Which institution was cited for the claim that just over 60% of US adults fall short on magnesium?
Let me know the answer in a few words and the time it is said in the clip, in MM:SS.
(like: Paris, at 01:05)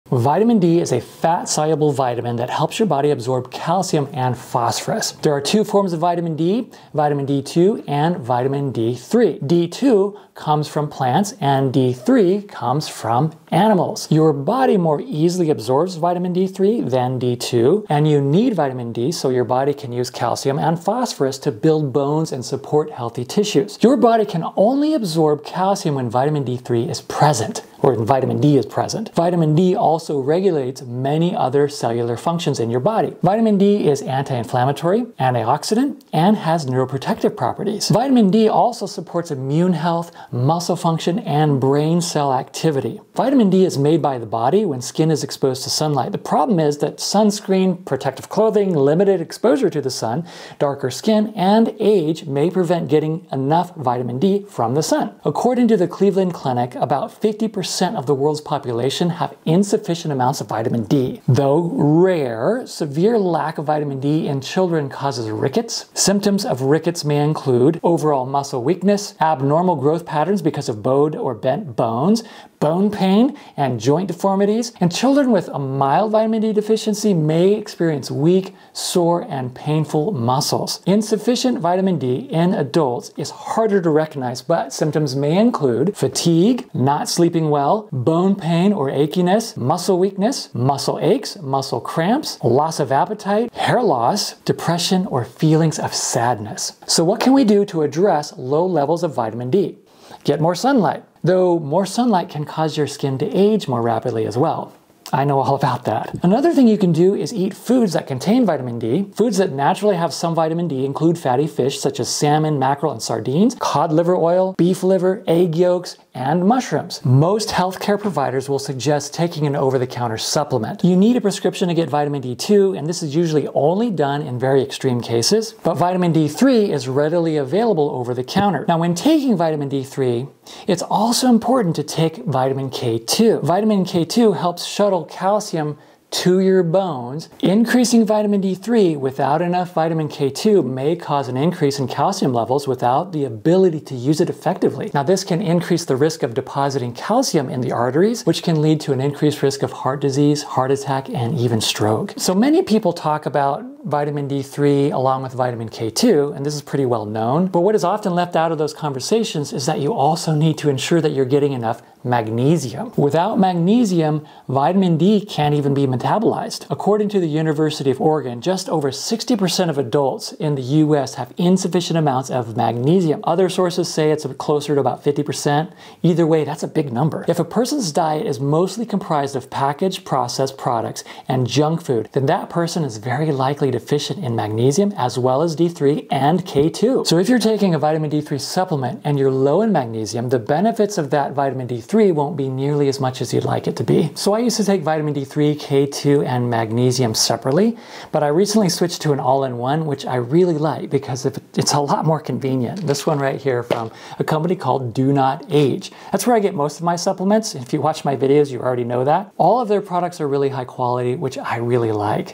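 University of Oregon, at 02:47.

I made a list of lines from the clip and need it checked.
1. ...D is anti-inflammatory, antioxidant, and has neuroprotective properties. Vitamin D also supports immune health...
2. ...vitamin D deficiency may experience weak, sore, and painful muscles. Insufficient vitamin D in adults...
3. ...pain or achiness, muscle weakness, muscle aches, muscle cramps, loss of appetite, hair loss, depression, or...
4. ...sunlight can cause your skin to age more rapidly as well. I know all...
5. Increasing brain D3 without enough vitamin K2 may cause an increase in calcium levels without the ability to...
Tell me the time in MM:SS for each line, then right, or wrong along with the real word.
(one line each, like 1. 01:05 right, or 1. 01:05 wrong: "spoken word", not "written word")
1. 00:33 right
2. 01:16 right
3. 01:28 right
4. 01:41 right
5. 02:17 wrong: "vitamin", not "brain".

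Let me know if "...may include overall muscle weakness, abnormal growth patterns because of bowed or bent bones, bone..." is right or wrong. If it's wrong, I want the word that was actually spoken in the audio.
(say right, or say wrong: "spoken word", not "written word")
right.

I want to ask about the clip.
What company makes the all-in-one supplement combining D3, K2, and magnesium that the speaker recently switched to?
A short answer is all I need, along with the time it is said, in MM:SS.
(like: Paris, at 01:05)
DoNotAge, at 03:24.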